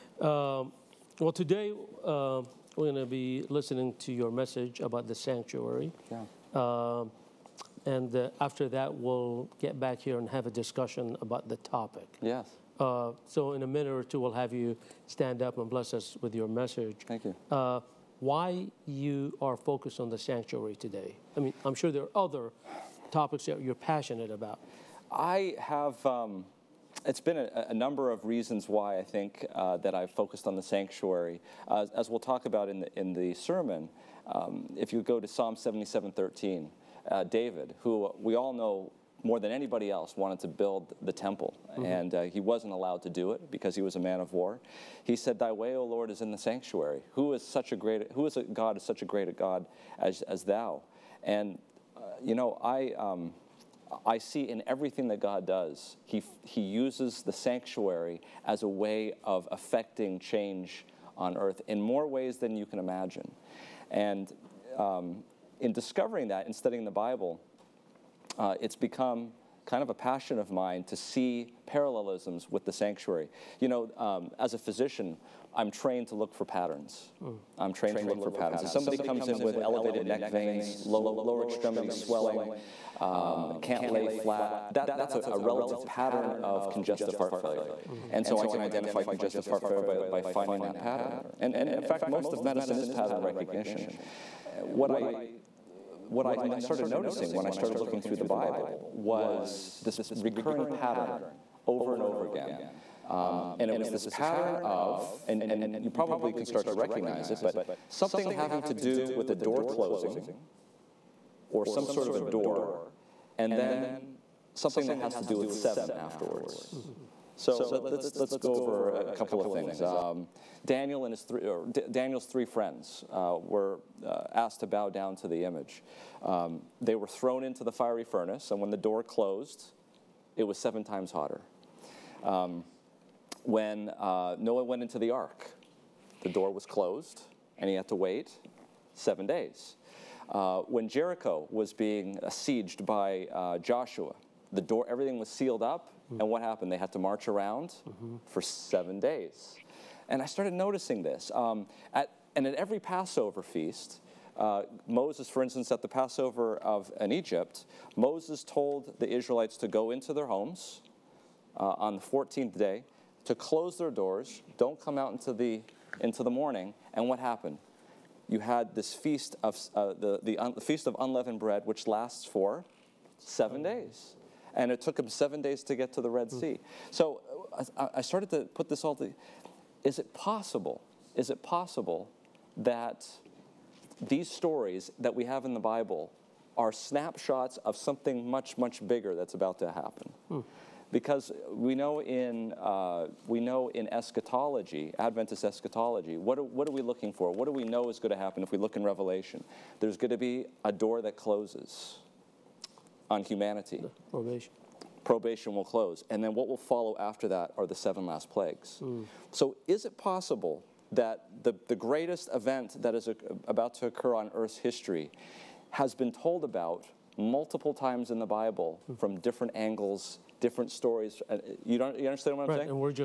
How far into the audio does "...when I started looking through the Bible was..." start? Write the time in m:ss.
1:37.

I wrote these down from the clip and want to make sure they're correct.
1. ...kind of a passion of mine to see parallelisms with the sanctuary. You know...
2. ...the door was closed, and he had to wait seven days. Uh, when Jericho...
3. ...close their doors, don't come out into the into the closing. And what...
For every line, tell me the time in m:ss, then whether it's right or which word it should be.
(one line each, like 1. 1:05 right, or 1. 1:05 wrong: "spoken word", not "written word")
1. 1:09 right
2. 2:16 right
3. 2:43 wrong: "morning", not "closing".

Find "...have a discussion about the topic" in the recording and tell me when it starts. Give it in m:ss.
0:10.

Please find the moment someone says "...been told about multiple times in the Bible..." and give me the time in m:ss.
3:35.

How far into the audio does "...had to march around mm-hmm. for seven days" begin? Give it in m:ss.
2:26.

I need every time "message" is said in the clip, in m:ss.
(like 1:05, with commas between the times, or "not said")
0:04, 0:16.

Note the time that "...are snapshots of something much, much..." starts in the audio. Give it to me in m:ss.
3:06.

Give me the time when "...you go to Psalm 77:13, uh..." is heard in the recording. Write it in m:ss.
0:34.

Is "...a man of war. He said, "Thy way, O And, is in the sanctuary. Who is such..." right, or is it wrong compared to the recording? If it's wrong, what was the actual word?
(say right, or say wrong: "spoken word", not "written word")
wrong: "Lord", not "And".